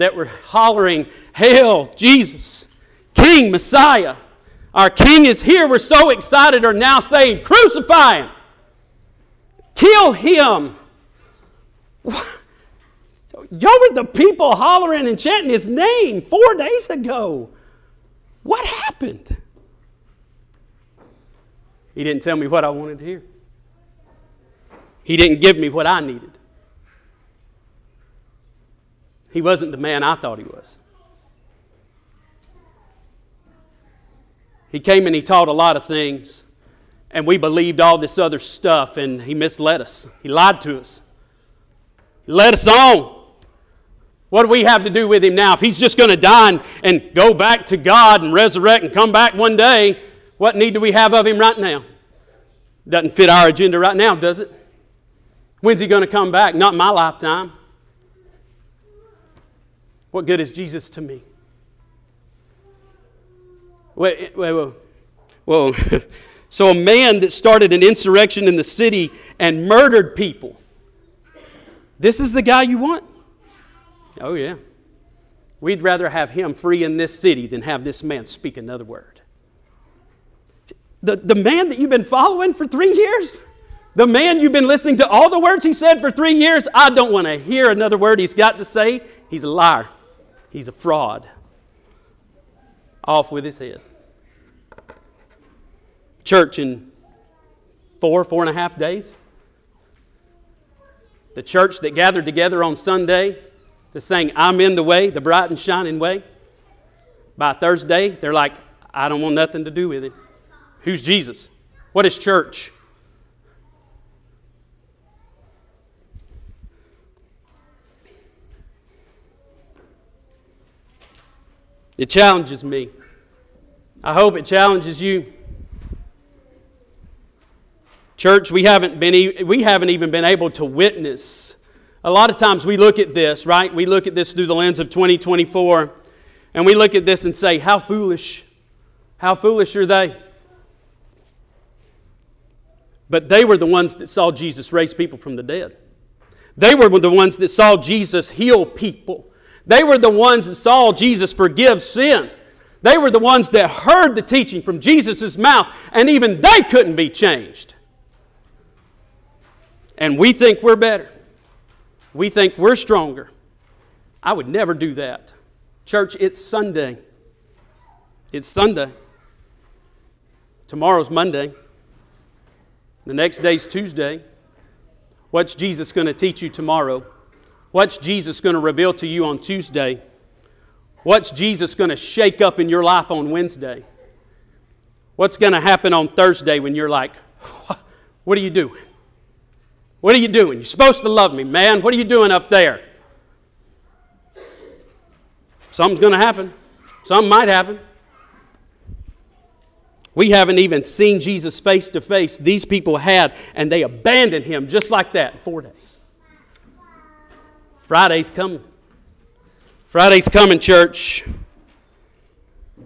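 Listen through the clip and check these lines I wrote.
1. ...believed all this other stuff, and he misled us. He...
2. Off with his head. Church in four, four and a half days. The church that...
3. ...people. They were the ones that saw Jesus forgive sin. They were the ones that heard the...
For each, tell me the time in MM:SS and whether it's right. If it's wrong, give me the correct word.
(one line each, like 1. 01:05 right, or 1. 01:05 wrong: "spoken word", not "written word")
1. 00:37 right
2. 01:33 right
3. 02:28 right.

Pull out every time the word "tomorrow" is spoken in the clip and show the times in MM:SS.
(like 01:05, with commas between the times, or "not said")
02:50, 02:56.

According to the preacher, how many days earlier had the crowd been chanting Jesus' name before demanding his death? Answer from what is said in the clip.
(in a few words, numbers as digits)
4 days.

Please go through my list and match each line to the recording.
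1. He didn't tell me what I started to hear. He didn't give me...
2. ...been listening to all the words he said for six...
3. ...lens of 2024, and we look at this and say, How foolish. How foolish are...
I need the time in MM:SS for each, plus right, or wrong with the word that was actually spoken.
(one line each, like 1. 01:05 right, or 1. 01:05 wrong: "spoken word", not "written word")
1. 00:21 wrong: "wanted", not "started"
2. 01:24 wrong: "three", not "six"
3. 02:14 right.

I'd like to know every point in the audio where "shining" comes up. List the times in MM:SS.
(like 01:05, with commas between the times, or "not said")
01:45.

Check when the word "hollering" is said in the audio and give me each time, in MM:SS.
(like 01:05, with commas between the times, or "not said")
00:00, 00:14.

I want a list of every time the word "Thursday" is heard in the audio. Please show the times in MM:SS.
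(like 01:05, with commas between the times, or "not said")
01:47, 03:06.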